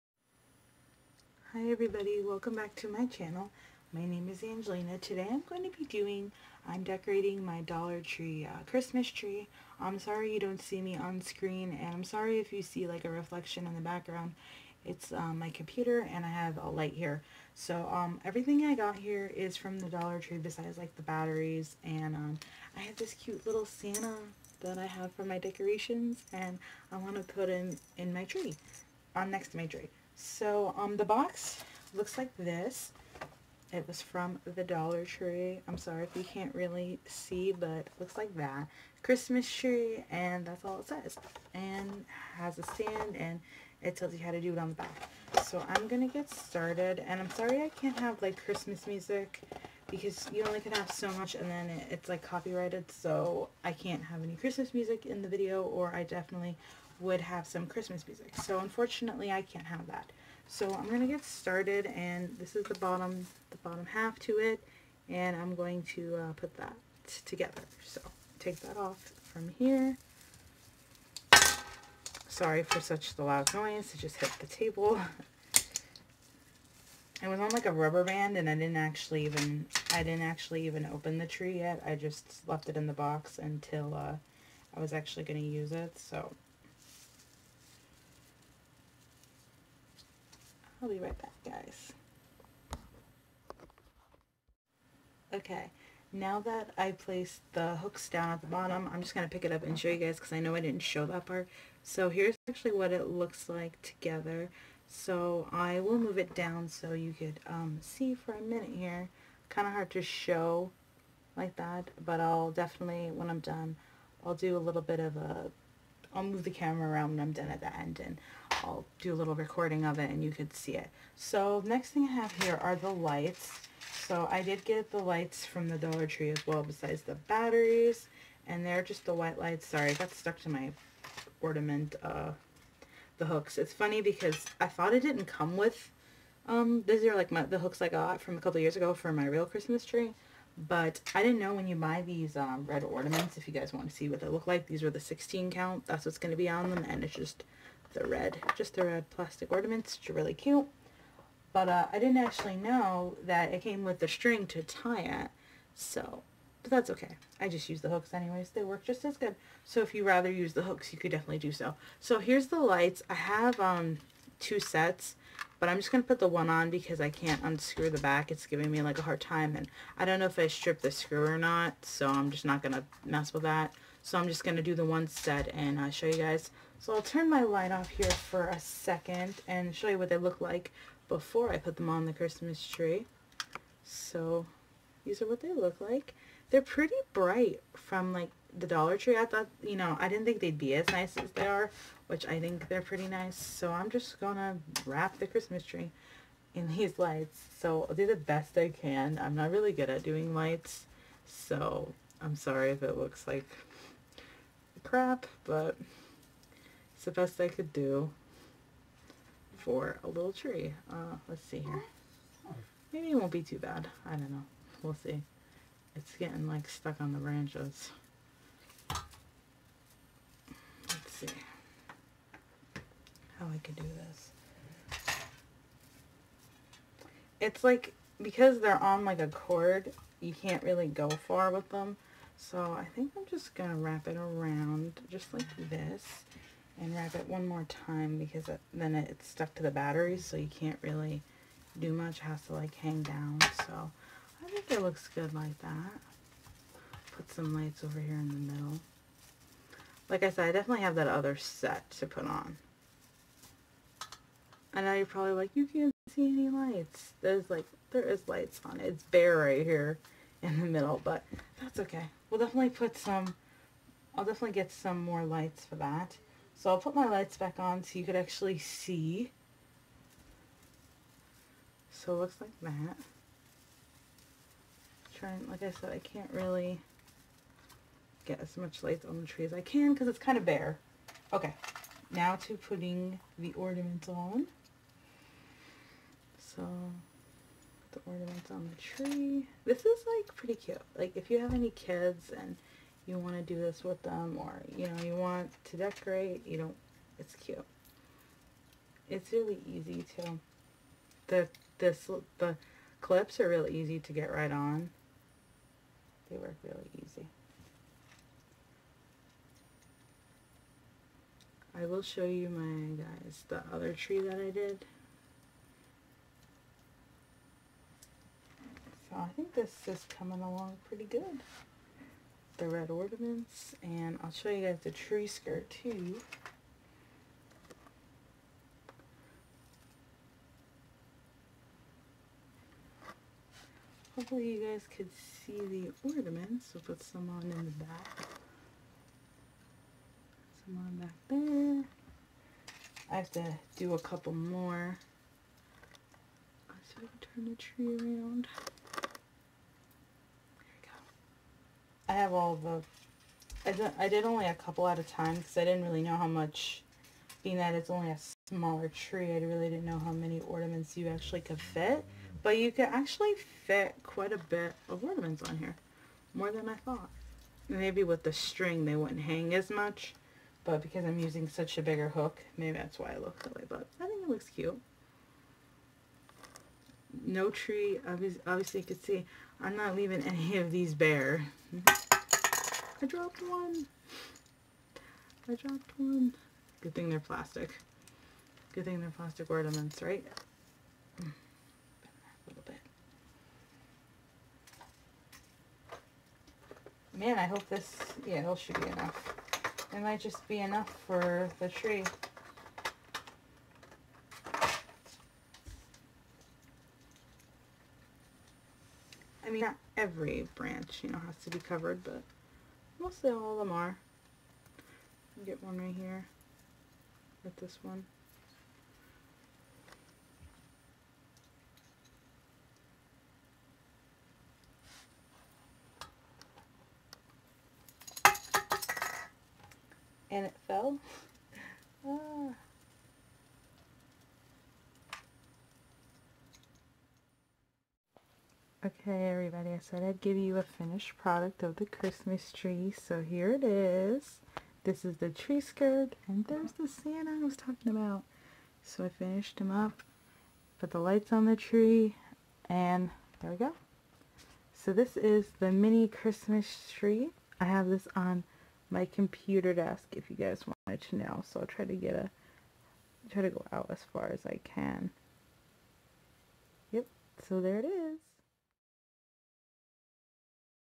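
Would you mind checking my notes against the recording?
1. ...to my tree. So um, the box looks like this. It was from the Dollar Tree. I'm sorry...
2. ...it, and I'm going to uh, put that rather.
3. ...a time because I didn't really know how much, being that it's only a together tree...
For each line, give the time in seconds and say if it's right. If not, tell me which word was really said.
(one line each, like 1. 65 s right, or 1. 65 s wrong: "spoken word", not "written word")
1. 29 s right
2. 64 s wrong: "together", not "rather"
3. 354 s wrong: "smaller", not "together".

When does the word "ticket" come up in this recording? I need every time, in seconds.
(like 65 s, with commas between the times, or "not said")
not said.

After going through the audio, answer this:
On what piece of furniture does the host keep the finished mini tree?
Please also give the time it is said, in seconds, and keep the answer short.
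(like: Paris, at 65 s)
computer desk, at 459 s.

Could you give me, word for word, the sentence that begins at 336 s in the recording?
We'll put some on in the back.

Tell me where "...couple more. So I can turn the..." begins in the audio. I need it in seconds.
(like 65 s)
343 s.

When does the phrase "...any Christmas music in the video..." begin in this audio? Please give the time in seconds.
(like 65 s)
54 s.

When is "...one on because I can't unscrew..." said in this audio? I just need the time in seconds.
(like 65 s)
166 s.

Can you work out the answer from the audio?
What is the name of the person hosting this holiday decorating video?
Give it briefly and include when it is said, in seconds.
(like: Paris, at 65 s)
Angelina, at 4 s.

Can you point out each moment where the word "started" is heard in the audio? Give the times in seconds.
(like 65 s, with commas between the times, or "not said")
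46 s, 61 s.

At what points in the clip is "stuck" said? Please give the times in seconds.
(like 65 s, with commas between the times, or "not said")
130 s, 216 s, 239 s.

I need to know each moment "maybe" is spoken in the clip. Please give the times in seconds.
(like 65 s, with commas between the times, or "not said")
212 s, 367 s, 372 s.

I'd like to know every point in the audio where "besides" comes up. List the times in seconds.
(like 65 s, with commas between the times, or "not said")
20 s, 126 s.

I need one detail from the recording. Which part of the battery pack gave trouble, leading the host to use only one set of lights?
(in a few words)
the screw.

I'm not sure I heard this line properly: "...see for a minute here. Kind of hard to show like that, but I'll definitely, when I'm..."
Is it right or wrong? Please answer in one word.
right.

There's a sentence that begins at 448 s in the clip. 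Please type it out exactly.
So I finished him up, put the lights on the tree, and there we go.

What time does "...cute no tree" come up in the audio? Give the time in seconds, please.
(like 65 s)
374 s.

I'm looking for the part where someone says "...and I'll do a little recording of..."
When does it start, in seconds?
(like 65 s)
118 s.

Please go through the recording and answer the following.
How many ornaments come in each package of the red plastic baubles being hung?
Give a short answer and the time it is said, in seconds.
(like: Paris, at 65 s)
16, at 144 s.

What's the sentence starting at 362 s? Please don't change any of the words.
But you could actually fit quite a bit of ornaments on here.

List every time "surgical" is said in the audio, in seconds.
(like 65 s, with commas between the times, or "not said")
not said.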